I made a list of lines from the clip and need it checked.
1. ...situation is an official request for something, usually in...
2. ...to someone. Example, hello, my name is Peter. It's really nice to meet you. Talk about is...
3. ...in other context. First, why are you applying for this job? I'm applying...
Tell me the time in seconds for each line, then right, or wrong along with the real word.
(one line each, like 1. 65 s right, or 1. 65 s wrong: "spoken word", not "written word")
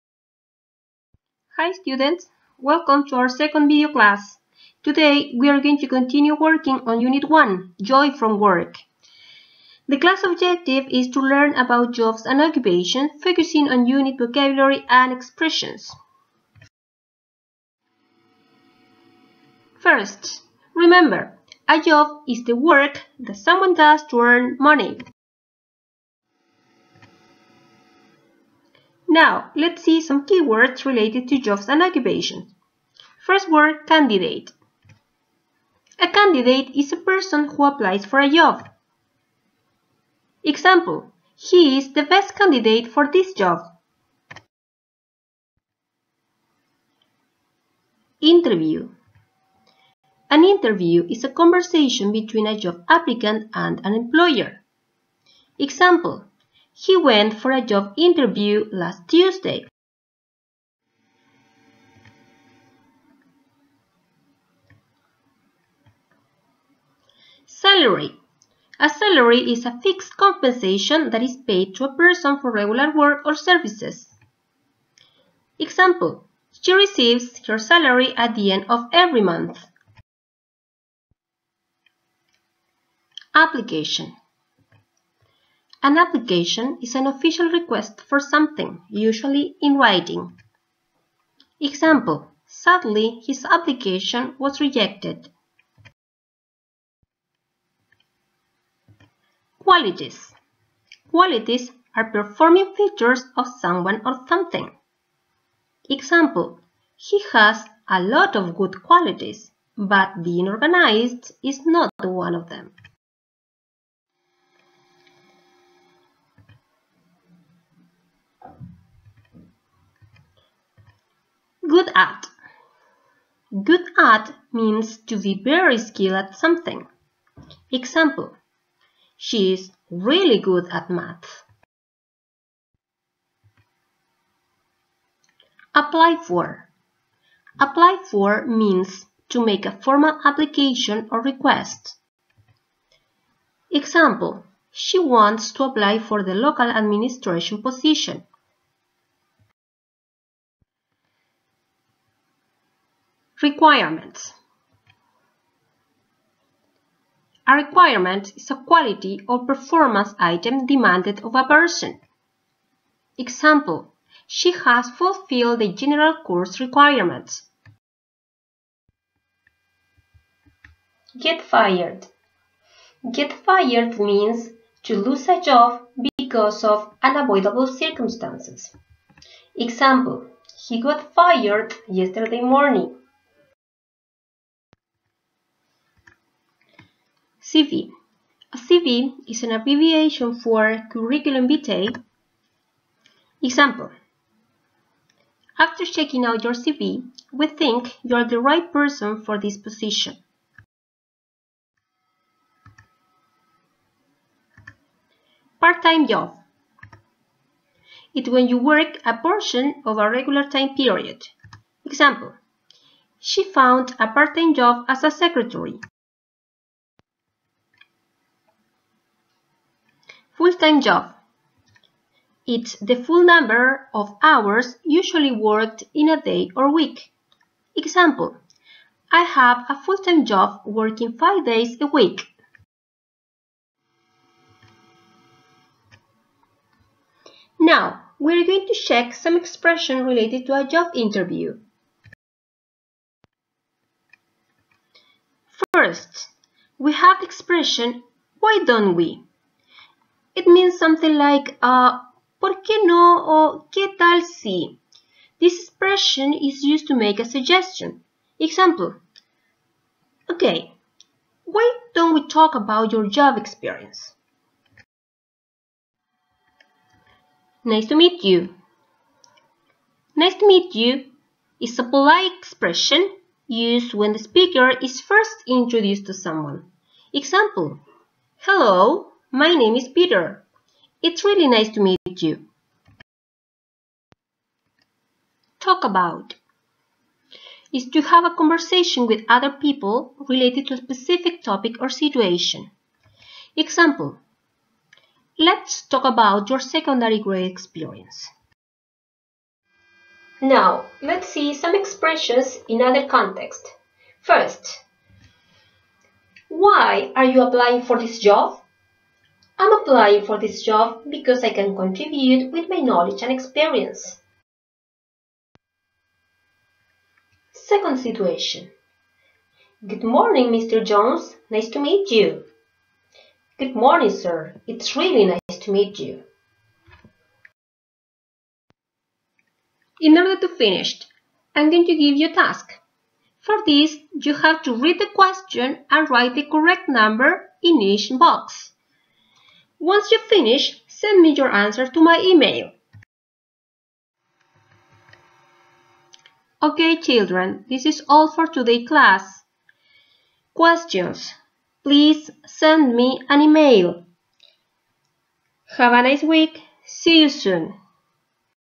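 1. 85 s wrong: "application", not "situation"
2. 276 s right
3. 302 s right.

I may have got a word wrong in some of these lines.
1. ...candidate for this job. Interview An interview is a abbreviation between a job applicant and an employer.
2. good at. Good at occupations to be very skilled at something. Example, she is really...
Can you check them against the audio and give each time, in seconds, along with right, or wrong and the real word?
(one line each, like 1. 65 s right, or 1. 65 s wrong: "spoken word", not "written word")
1. 42 s wrong: "conversation", not "abbreviation"
2. 121 s wrong: "means", not "occupations".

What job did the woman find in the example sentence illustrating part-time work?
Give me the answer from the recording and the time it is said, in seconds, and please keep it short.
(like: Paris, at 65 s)
secretary, at 215 s.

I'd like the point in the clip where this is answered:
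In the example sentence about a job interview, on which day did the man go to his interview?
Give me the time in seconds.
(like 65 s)
58 s.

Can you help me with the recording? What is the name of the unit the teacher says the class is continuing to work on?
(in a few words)
Joy from Work.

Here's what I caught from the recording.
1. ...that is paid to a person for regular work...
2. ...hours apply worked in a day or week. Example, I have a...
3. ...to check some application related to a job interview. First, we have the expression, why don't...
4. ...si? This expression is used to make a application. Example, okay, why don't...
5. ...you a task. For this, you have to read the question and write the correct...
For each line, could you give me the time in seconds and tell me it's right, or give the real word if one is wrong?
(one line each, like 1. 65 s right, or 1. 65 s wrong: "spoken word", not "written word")
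1. 71 s right
2. 224 s wrong: "usually", not "apply"
3. 238 s wrong: "expression", not "application"
4. 254 s wrong: "suggestion", not "application"
5. 332 s right.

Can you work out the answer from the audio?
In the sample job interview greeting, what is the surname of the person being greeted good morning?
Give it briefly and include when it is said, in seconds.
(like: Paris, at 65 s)
Jones, at 320 s.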